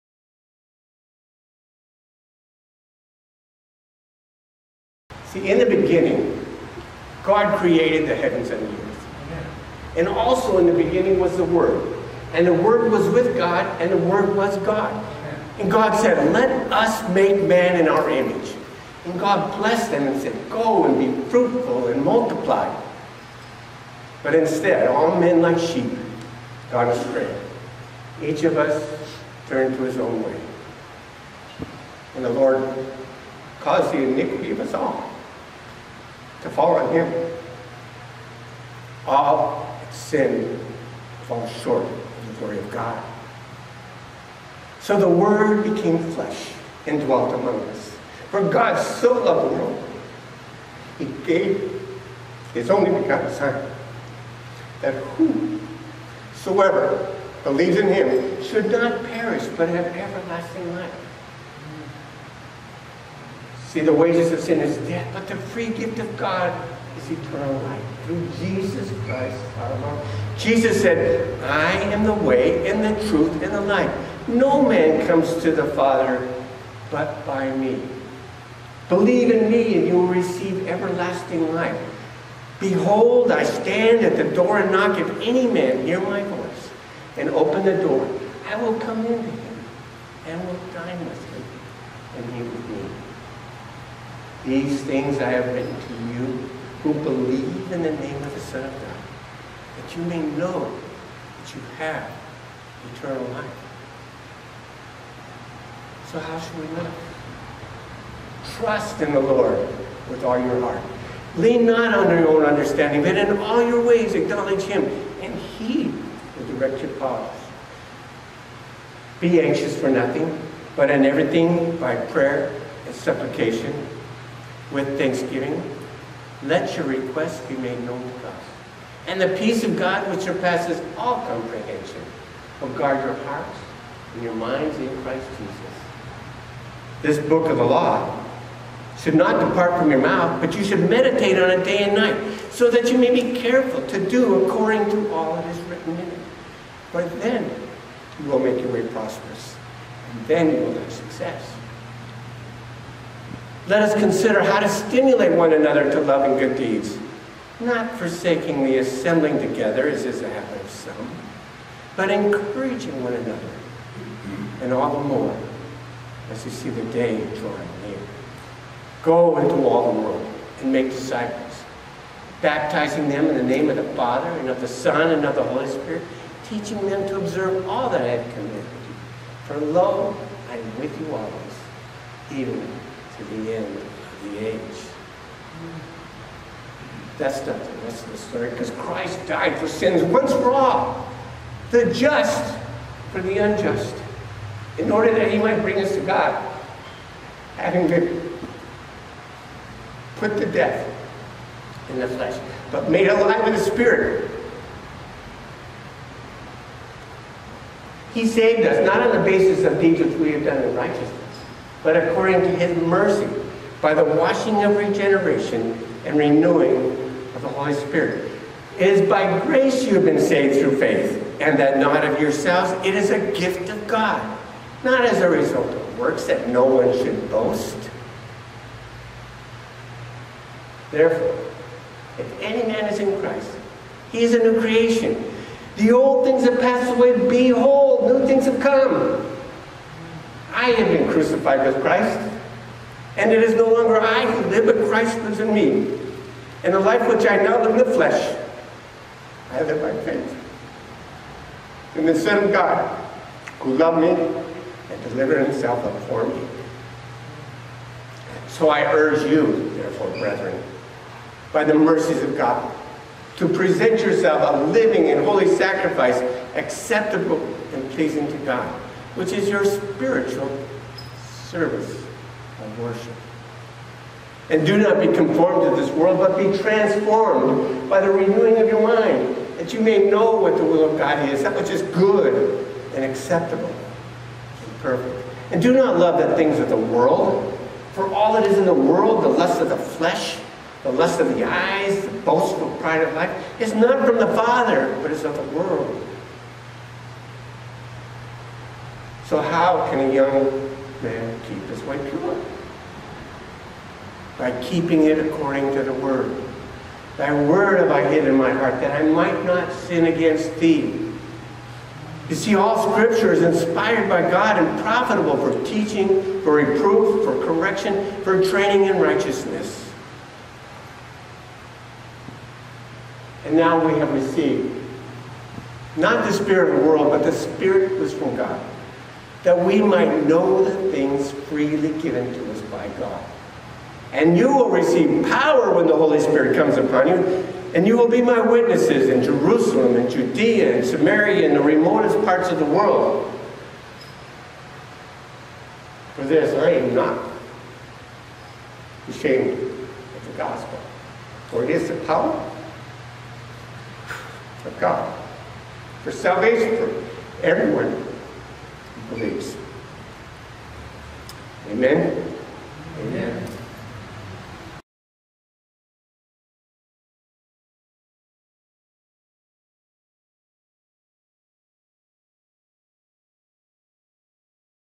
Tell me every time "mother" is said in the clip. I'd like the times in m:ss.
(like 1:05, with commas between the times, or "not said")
not said.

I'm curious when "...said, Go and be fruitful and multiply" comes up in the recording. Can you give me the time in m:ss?
0:20.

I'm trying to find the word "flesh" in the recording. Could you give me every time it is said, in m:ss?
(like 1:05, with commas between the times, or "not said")
0:46, 3:22, 4:07, 4:49.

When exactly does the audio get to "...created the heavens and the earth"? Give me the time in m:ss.
0:07.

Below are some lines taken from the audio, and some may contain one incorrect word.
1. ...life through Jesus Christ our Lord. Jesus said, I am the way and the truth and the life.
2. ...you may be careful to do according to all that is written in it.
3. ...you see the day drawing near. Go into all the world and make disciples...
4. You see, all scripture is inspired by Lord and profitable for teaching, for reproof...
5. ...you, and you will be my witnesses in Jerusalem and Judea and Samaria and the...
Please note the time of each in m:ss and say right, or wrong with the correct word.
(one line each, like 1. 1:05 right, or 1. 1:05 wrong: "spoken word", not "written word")
1. 1:07 right
2. 2:22 right
3. 2:46 right
4. 5:12 wrong: "God", not "Lord"
5. 5:37 right.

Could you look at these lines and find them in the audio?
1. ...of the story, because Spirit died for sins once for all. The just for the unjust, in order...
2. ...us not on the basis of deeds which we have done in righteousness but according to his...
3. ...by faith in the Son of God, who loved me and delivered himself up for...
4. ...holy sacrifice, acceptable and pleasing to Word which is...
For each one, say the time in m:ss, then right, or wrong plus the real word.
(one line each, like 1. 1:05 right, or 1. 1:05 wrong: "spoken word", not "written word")
1. 3:08 wrong: "Christ", not "Spirit"
2. 3:28 right
3. 4:09 right
4. 4:25 wrong: "God", not "Word".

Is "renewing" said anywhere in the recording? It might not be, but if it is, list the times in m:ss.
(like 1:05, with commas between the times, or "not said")
3:36, 4:38.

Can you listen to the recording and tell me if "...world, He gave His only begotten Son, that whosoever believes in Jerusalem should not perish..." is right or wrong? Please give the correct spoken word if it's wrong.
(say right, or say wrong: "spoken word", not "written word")
wrong: "Him", not "Jerusalem".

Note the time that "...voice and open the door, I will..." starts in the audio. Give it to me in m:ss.
1:26.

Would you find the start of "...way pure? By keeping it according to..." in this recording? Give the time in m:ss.
5:01.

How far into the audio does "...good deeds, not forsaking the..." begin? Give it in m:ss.
2:36.